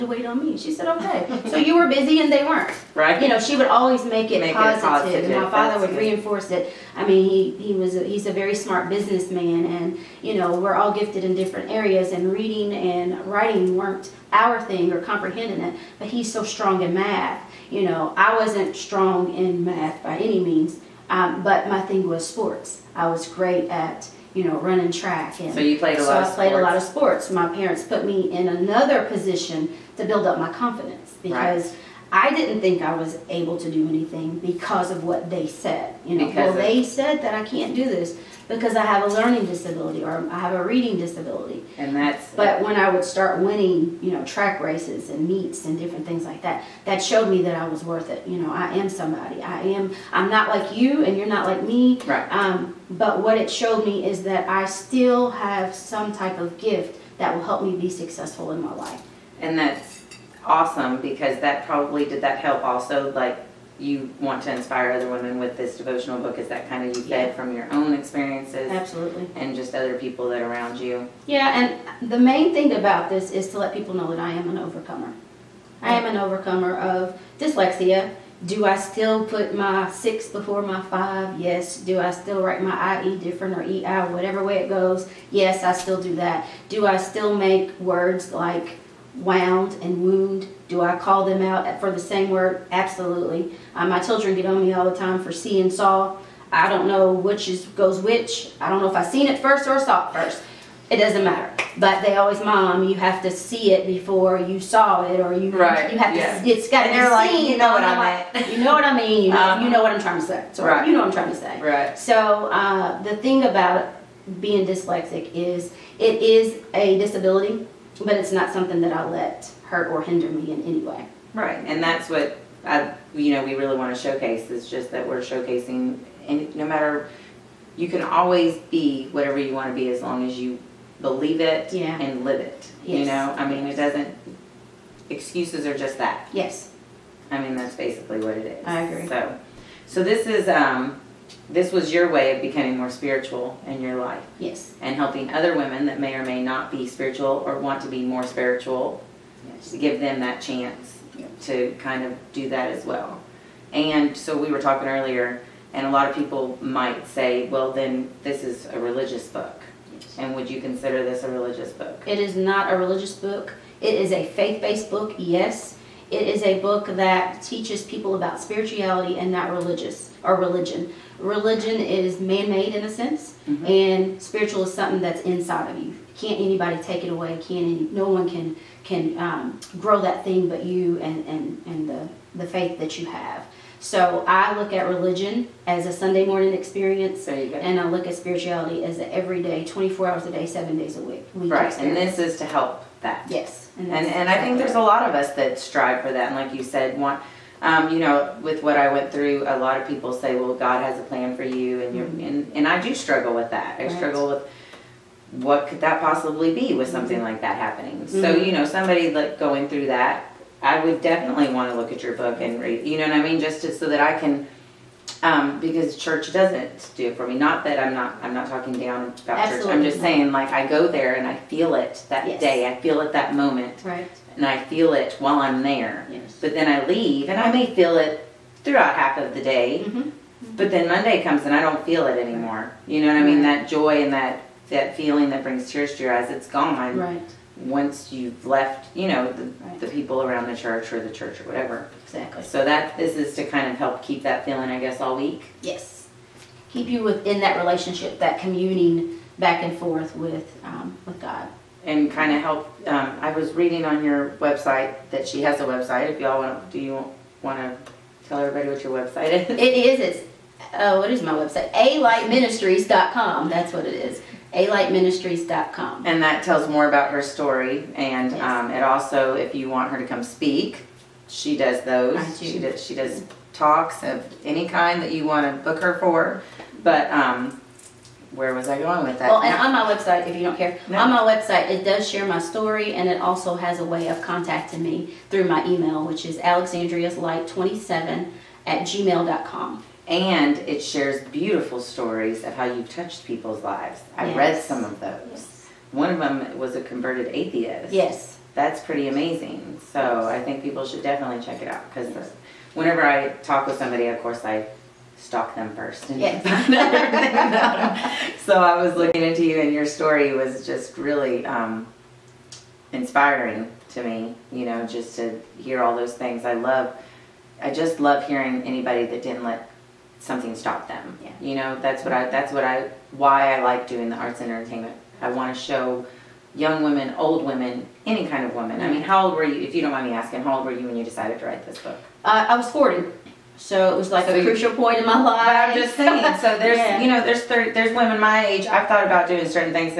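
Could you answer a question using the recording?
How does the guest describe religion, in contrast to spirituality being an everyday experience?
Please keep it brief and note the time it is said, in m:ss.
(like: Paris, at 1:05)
A Sunday morning experience, at 3:05.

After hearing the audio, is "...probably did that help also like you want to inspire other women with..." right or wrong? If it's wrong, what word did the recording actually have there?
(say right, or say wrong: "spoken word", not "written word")
right.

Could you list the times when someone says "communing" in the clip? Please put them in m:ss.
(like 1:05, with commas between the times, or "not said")
4:08.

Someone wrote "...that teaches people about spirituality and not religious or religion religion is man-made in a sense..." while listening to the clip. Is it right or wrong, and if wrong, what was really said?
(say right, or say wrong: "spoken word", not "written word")
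right.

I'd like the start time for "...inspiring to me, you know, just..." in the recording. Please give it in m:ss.
5:12.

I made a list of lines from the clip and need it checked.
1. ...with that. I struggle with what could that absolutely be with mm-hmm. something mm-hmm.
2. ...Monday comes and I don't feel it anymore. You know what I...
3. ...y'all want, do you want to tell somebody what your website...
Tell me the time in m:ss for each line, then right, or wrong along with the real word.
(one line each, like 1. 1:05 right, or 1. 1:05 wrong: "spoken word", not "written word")
1. 3:23 wrong: "possibly", not "absolutely"
2. 3:50 right
3. 4:16 wrong: "everybody", not "somebody".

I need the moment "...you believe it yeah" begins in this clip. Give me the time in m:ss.
2:10.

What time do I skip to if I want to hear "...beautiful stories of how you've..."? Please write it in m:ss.
4:51.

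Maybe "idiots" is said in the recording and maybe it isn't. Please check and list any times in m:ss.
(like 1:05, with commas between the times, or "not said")
not said.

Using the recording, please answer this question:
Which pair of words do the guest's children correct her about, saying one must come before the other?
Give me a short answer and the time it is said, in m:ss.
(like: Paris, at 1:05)
See and saw, at 1:35.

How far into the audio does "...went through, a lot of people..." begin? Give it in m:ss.
3:18.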